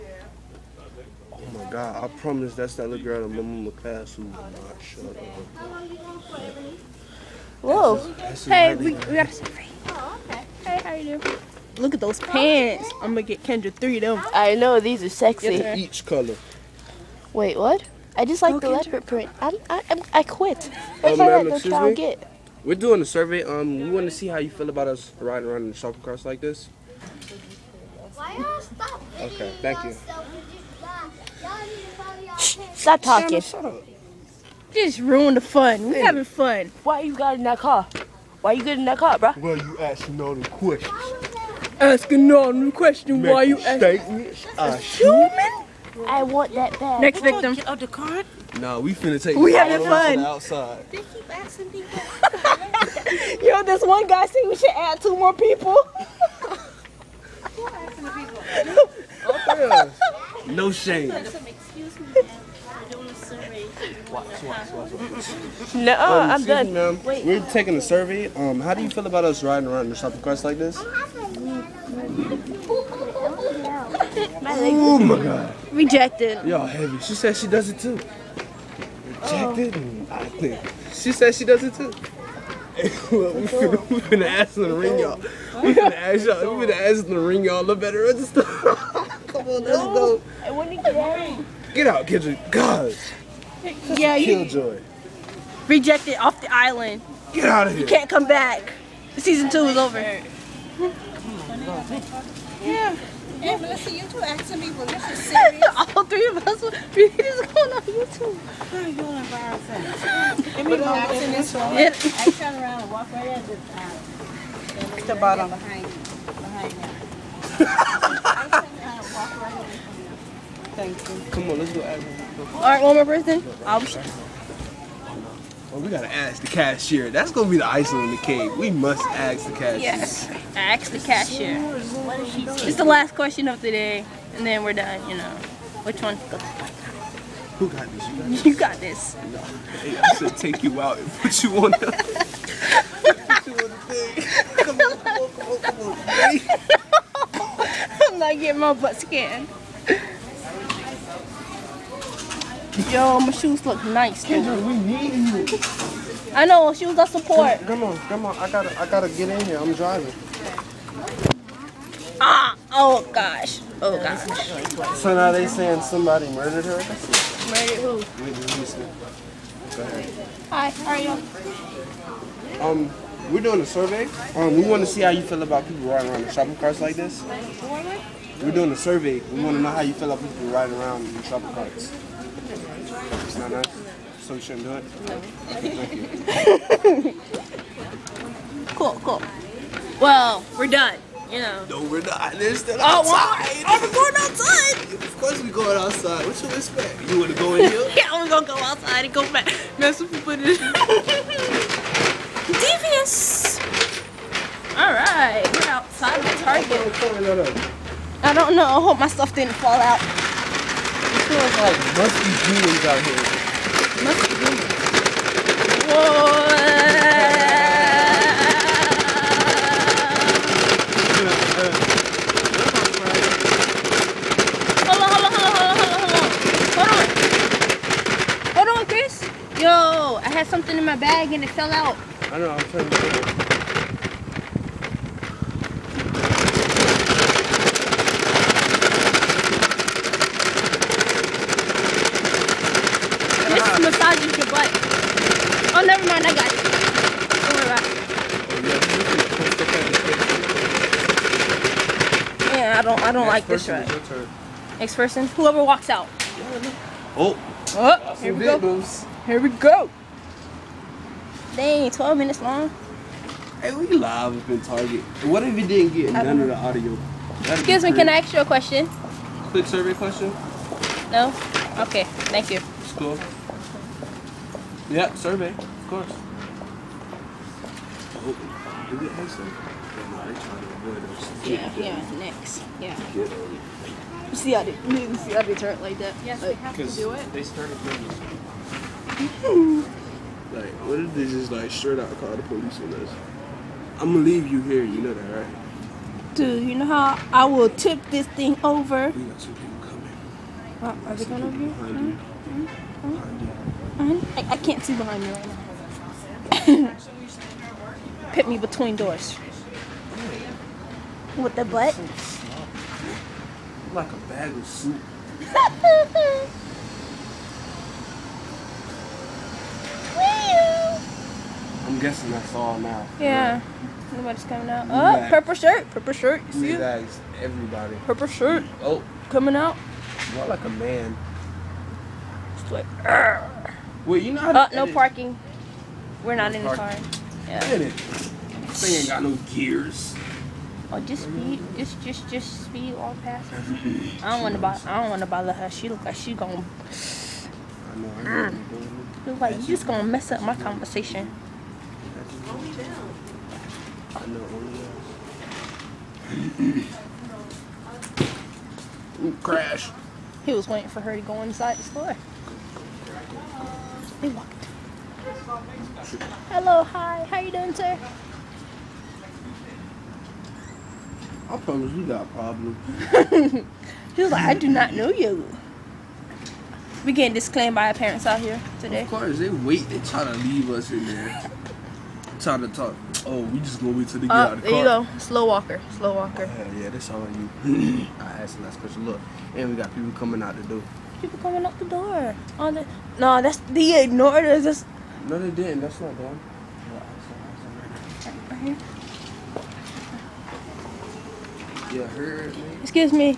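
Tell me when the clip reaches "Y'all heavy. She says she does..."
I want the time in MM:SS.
01:16.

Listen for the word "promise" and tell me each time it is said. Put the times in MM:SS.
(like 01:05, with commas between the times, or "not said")
00:02, 06:11.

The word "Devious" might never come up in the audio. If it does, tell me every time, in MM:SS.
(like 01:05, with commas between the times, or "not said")
03:22.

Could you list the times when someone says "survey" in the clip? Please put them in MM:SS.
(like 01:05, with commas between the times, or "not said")
00:23, 01:07, 02:53, 02:58, 04:29, 04:35.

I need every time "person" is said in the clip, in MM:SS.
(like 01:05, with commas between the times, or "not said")
02:03, 04:14.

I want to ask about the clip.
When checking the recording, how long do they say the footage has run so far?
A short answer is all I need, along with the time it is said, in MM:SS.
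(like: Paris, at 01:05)
12 minutes, at 04:21.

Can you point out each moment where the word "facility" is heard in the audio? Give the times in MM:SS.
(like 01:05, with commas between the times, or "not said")
not said.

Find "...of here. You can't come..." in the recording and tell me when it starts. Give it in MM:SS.
01:37.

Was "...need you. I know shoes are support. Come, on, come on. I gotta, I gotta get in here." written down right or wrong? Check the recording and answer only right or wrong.
right.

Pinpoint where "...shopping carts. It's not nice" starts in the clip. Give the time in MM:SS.
03:01.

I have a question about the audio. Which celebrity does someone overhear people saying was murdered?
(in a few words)
Whitney Houston.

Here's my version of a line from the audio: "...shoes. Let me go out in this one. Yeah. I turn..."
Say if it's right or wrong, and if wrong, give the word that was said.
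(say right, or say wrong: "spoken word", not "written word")
wrong: "ourselves", not "shoes".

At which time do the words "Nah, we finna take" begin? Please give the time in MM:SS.
00:48.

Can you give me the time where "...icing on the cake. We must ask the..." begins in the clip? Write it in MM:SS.
02:07.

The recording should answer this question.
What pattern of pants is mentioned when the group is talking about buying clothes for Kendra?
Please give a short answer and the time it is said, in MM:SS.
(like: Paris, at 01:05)
leopard print, at 00:18.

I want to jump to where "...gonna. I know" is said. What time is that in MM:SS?
05:46.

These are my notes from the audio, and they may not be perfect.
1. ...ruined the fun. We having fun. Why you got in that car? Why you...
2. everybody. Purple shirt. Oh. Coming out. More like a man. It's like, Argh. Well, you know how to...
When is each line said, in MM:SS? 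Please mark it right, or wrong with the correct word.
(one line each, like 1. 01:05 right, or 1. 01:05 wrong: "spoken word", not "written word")
1. 00:34 right
2. 05:27 right.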